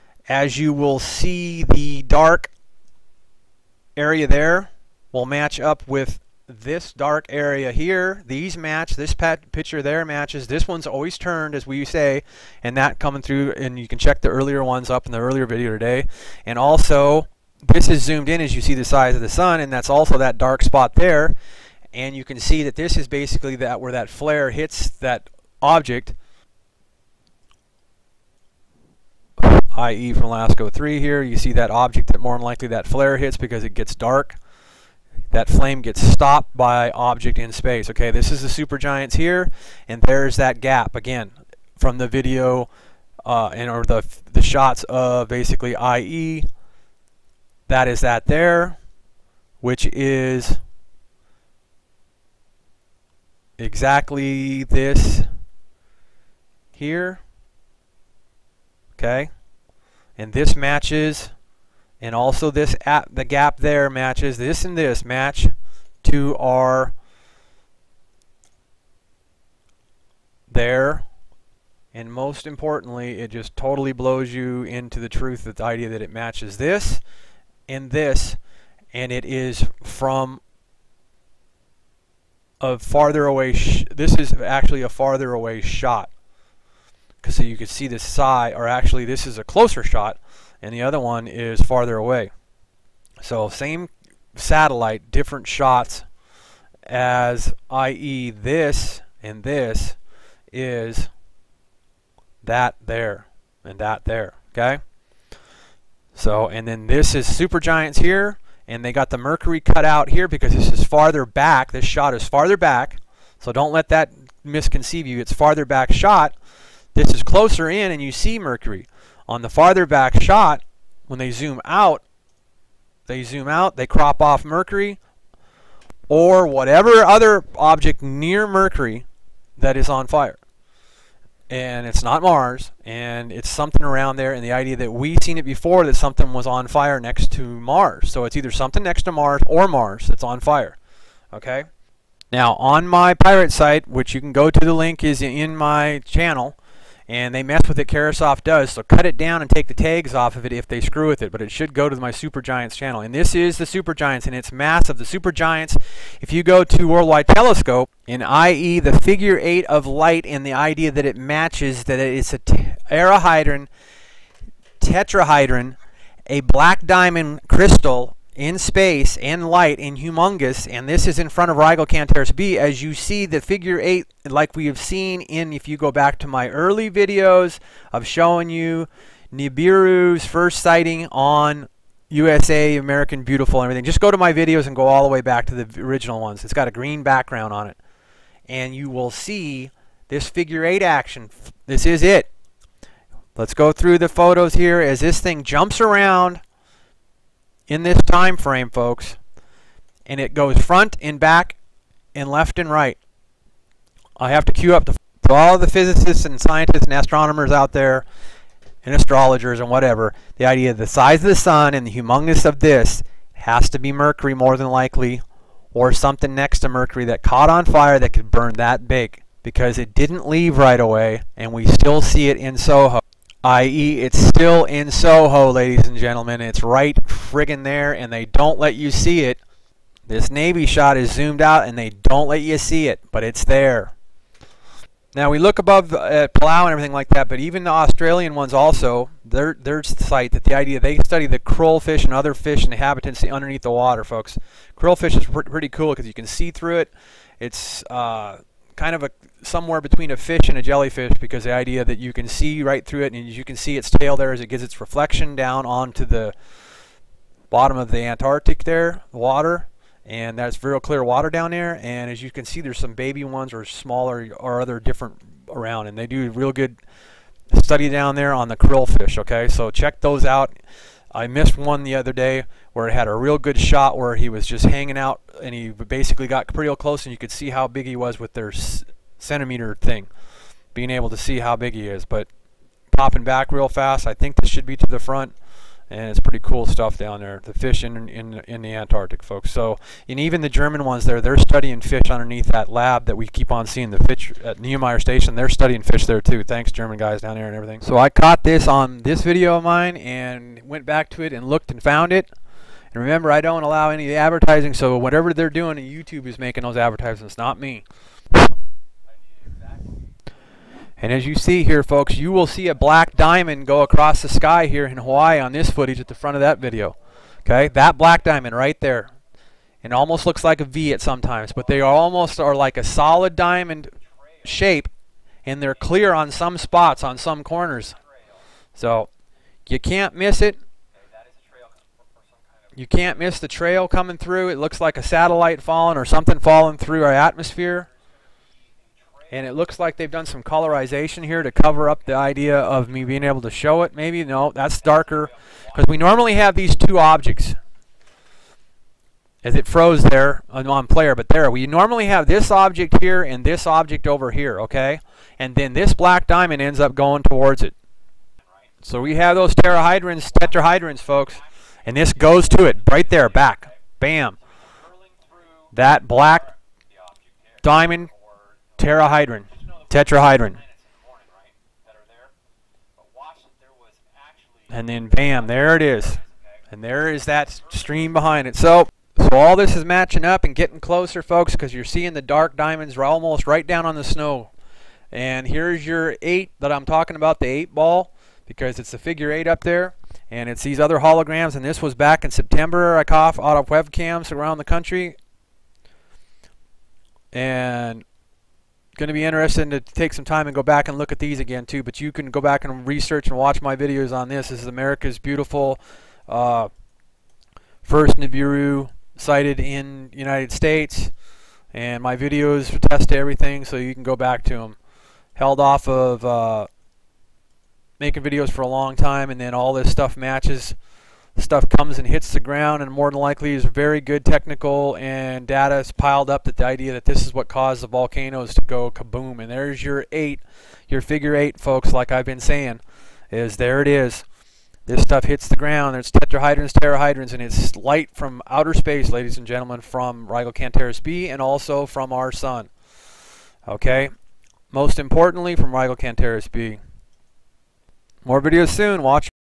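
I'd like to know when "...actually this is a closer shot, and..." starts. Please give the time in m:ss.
1:28.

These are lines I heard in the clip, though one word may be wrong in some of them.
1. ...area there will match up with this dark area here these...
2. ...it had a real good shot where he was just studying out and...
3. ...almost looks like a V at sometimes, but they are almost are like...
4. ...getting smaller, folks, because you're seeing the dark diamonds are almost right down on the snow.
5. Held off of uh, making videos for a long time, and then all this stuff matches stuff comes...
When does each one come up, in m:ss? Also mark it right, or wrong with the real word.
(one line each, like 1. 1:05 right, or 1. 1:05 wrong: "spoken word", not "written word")
1. 0:03 right
2. 4:32 wrong: "hanging", not "studying"
3. 5:19 right
4. 6:20 wrong: "closer", not "smaller"
5. 6:55 right.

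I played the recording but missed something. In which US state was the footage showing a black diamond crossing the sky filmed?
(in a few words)
Hawaii.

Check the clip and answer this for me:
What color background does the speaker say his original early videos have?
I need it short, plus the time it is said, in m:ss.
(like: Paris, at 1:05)
Green, at 3:06.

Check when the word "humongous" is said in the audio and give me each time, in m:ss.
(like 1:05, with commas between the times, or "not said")
2:49, 3:31.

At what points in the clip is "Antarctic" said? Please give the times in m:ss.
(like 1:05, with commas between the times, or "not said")
4:17, 4:48.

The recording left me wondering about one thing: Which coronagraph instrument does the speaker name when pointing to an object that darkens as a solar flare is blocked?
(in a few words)
LASCO 3.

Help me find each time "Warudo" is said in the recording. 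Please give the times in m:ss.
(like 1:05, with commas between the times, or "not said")
not said.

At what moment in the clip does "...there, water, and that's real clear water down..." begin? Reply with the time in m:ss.
4:18.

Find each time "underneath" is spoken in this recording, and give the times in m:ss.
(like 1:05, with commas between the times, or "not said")
4:03, 4:52.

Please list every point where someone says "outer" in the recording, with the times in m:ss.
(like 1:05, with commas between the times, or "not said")
7:18.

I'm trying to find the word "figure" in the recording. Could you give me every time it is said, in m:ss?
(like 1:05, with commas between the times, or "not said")
2:39, 2:53, 3:10, 6:28, 7:11.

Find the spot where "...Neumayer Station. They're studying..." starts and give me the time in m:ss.
4:54.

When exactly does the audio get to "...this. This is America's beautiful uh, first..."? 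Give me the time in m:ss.
6:44.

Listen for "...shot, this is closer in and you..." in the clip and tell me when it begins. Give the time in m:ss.
1:55.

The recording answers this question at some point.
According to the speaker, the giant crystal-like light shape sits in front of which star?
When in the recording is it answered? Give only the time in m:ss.
2:51.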